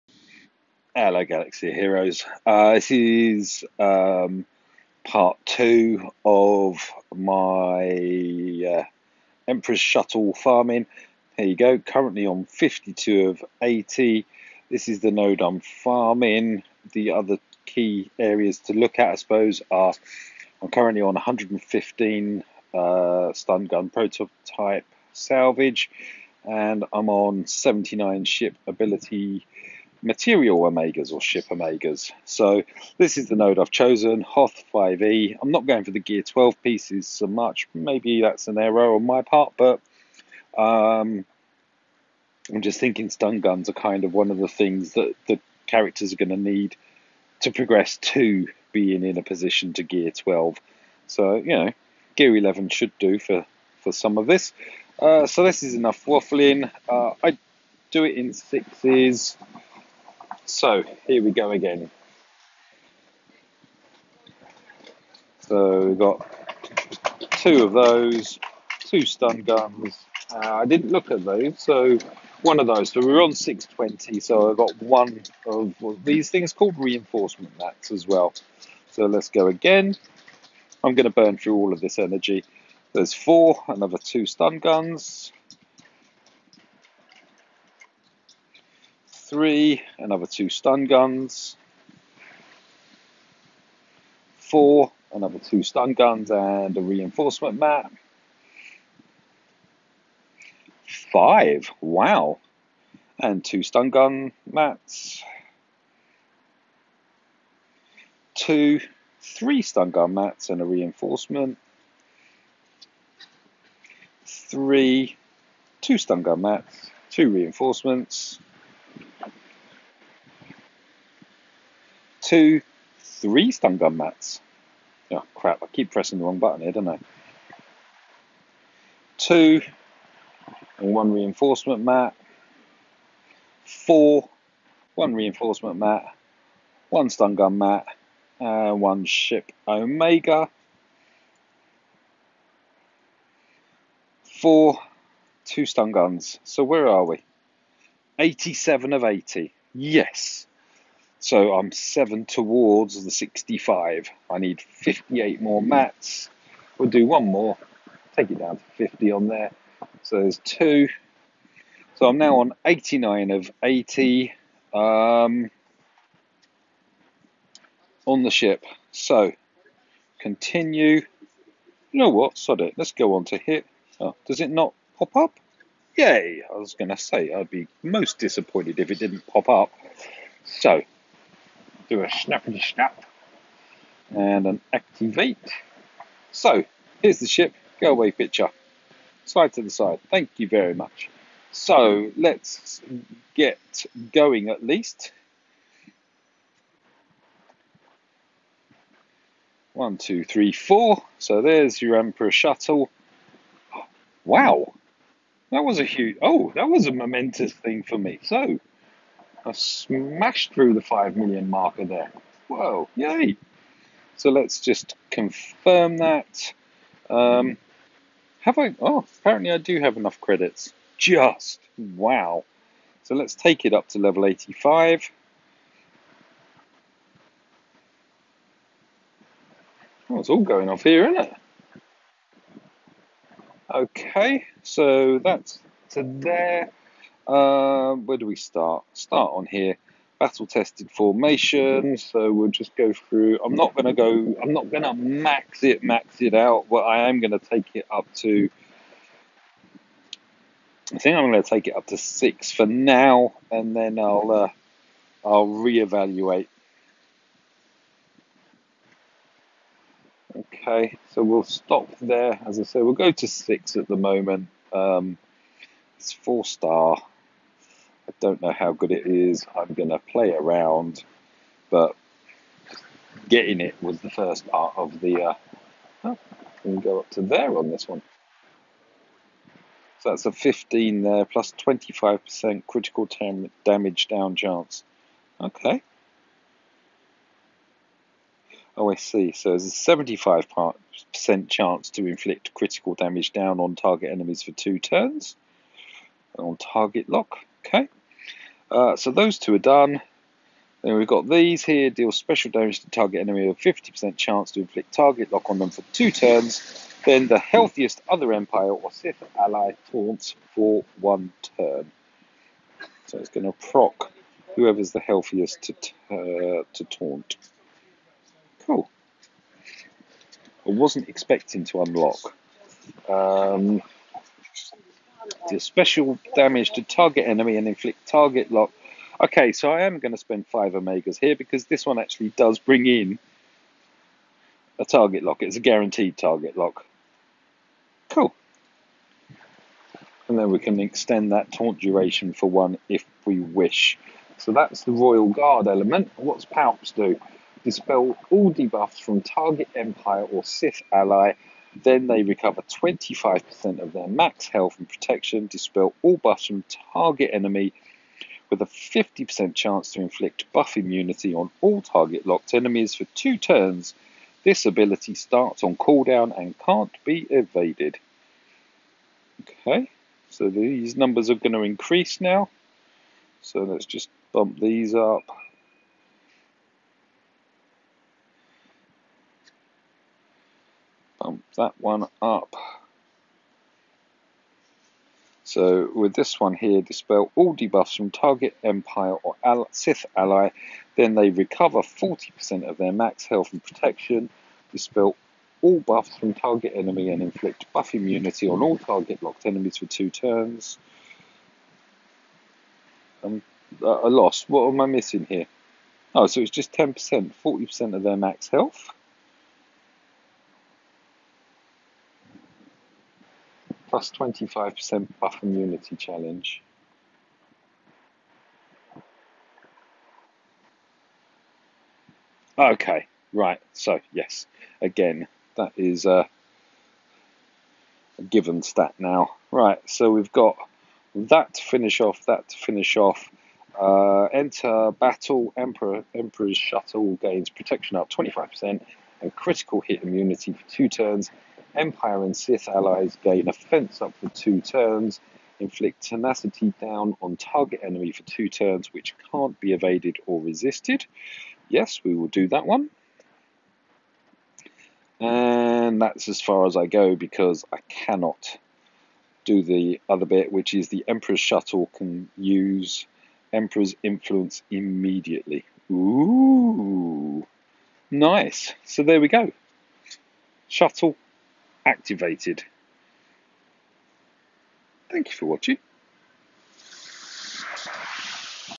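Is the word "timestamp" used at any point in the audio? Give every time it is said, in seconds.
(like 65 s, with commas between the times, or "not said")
not said.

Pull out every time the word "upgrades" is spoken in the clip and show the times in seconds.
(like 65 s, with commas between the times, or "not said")
not said.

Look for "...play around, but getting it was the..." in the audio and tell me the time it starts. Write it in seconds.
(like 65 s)
269 s.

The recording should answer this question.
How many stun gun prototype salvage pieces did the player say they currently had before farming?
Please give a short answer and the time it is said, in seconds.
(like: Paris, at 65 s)
115, at 21 s.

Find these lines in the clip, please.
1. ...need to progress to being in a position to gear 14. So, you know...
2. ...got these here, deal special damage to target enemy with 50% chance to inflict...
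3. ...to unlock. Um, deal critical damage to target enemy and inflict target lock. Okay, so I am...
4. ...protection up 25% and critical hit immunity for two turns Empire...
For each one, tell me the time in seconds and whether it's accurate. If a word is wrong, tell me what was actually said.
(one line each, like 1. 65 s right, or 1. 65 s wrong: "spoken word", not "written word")
1. 46 s wrong: "12", not "14"
2. 301 s right
3. 321 s wrong: "special", not "critical"
4. 437 s right.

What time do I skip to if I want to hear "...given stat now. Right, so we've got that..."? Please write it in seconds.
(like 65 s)
428 s.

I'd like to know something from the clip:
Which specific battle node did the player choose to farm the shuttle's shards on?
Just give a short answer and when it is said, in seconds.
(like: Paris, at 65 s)
Hoth 5e, at 34 s.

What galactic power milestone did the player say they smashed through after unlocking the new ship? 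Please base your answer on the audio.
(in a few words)
5 million.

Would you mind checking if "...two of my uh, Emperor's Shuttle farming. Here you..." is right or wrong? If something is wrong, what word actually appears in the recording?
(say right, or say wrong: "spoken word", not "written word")
right.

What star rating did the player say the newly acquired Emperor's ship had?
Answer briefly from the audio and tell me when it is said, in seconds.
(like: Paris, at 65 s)
4, at 266 s.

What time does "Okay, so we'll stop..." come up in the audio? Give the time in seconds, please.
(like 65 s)
260 s.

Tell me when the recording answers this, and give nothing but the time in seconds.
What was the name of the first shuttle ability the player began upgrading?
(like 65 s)
240 s.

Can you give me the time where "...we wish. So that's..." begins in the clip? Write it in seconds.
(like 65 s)
343 s.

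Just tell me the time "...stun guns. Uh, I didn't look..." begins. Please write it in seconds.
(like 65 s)
69 s.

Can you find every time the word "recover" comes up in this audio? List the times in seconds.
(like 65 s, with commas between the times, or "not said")
352 s, 391 s.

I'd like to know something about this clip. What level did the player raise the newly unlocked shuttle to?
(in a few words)
85.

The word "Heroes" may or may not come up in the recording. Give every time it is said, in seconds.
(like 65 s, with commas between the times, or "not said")
1 s.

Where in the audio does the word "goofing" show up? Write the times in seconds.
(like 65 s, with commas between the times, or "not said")
not said.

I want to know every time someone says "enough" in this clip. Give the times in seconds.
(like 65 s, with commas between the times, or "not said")
55 s, 219 s.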